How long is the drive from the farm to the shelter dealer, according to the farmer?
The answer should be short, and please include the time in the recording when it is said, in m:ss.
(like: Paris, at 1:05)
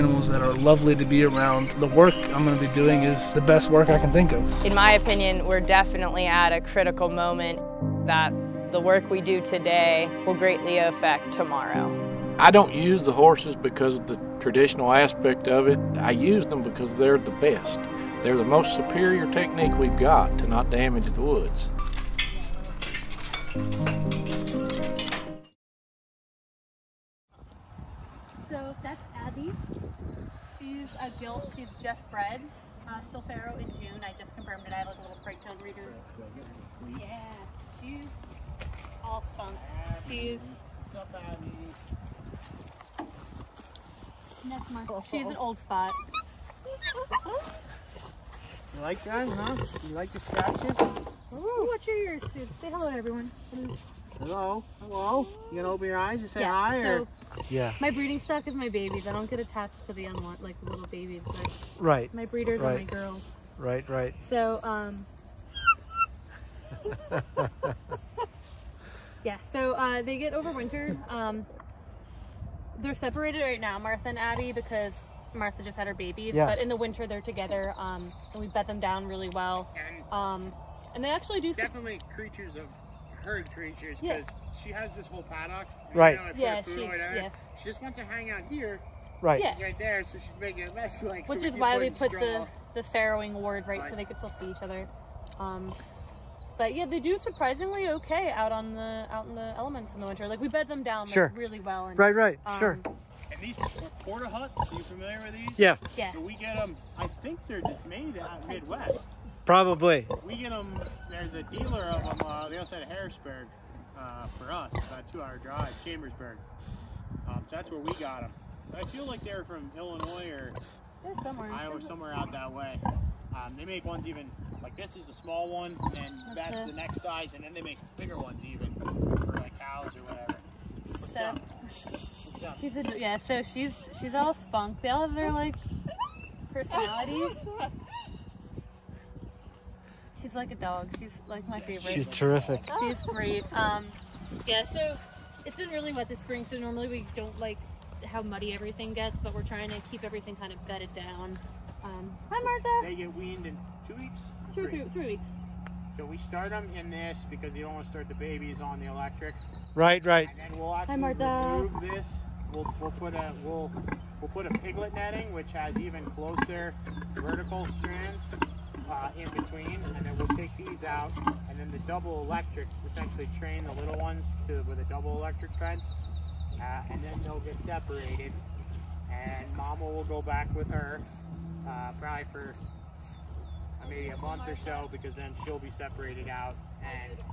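2 hours, at 1:55.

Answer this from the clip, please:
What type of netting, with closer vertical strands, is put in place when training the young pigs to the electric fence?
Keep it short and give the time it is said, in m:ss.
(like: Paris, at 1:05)
piglet netting, at 2:44.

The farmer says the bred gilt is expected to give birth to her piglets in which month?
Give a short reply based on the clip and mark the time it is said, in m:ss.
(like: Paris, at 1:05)
June, at 0:33.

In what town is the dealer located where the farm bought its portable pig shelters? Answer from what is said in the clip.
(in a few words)
Chambersburg.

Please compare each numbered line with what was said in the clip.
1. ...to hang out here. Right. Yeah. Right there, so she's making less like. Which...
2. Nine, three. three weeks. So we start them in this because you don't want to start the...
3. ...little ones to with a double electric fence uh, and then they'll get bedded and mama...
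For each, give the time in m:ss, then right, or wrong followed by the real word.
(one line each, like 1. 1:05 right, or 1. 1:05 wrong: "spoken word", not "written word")
1. 1:27 right
2. 2:34 wrong: "Two", not "Nine"
3. 2:53 wrong: "separated", not "bedded".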